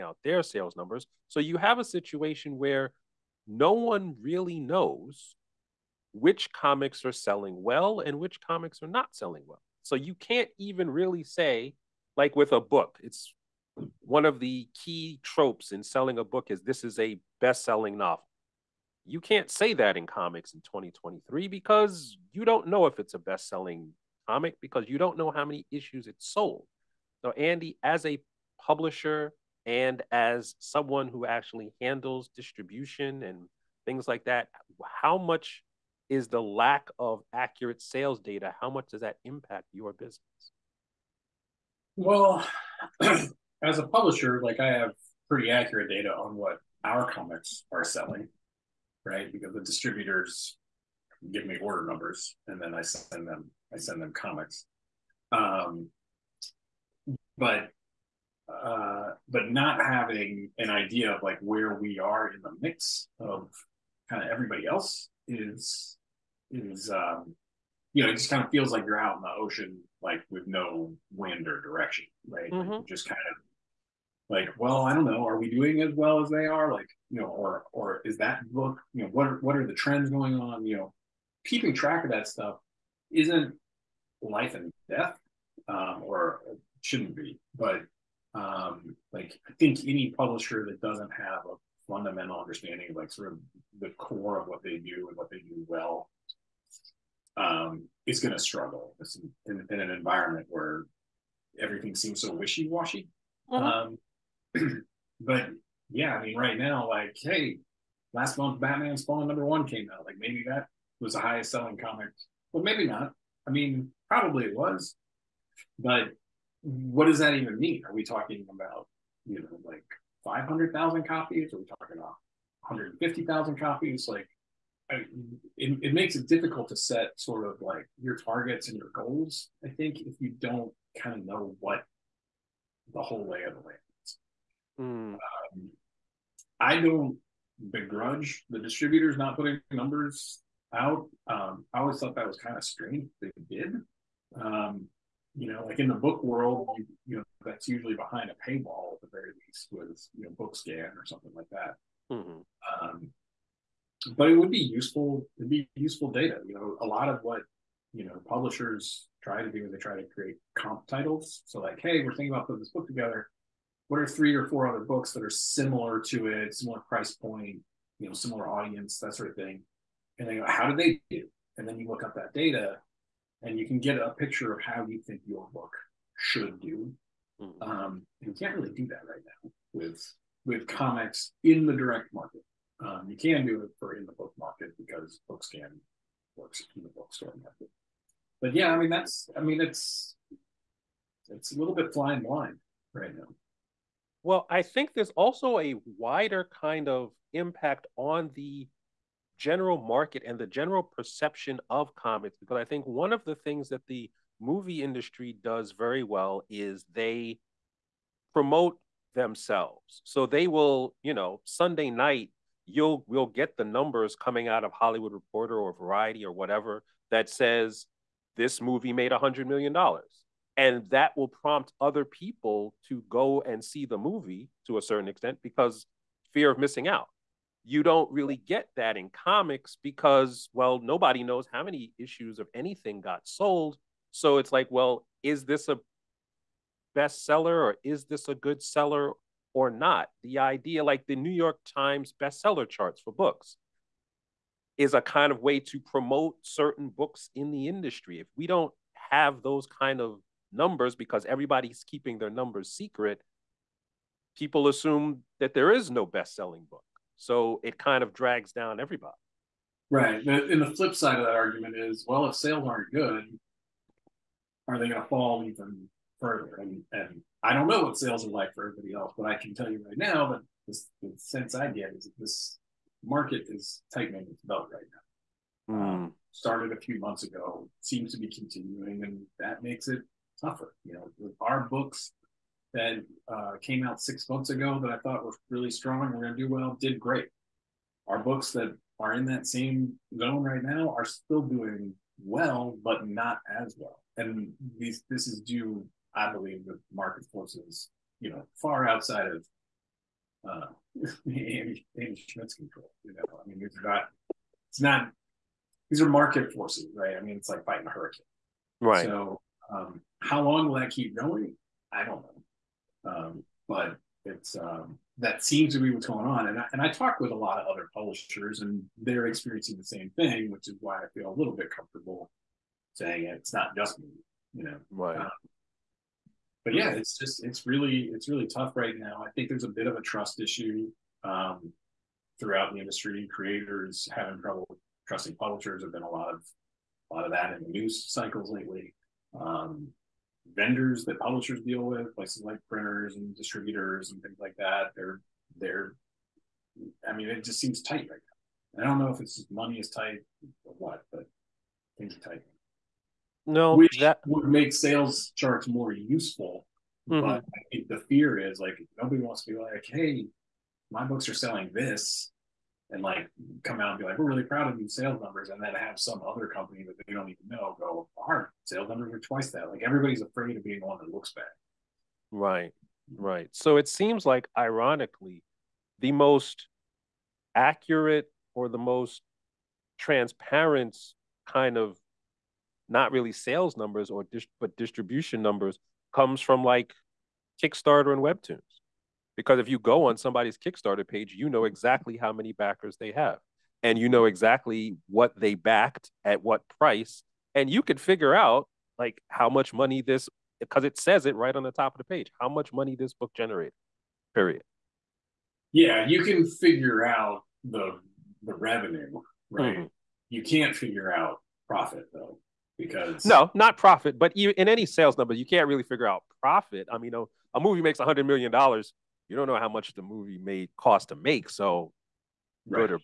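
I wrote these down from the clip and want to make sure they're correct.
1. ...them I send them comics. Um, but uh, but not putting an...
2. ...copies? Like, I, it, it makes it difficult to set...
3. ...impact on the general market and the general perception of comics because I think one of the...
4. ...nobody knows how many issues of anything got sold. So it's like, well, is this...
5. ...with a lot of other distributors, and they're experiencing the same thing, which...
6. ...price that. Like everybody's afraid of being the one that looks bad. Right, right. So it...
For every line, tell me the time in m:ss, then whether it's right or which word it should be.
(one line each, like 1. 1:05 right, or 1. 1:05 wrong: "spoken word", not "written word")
1. 0:53 wrong: "having", not "putting"
2. 2:03 right
3. 3:17 right
4. 3:50 right
5. 5:17 wrong: "publishers", not "distributors"
6. 6:09 wrong: "twice", not "price".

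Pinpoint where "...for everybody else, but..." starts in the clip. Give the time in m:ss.
4:28.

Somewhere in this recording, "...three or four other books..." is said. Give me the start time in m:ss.
2:44.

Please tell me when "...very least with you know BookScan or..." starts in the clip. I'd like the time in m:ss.
2:29.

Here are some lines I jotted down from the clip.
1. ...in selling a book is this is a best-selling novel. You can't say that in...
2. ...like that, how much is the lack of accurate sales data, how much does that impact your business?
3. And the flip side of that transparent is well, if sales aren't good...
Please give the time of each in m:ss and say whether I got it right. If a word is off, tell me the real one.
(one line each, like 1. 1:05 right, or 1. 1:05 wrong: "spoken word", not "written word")
1. 0:15 right
2. 0:34 right
3. 4:20 wrong: "argument", not "transparent".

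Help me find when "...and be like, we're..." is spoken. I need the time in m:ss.
6:03.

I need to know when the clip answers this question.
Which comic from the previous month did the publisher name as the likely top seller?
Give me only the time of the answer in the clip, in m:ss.
1:48.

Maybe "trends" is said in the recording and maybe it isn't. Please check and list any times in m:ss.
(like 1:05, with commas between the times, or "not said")
1:19.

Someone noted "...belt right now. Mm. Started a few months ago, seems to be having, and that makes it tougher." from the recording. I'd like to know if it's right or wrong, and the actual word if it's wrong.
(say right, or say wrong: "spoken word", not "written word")
wrong: "continuing", not "having".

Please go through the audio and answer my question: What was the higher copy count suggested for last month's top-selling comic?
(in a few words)
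500,000.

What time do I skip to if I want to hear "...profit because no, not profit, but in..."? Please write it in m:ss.
6:51.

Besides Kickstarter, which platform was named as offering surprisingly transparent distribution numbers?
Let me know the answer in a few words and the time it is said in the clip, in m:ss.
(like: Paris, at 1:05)
Webtoons, at 6:28.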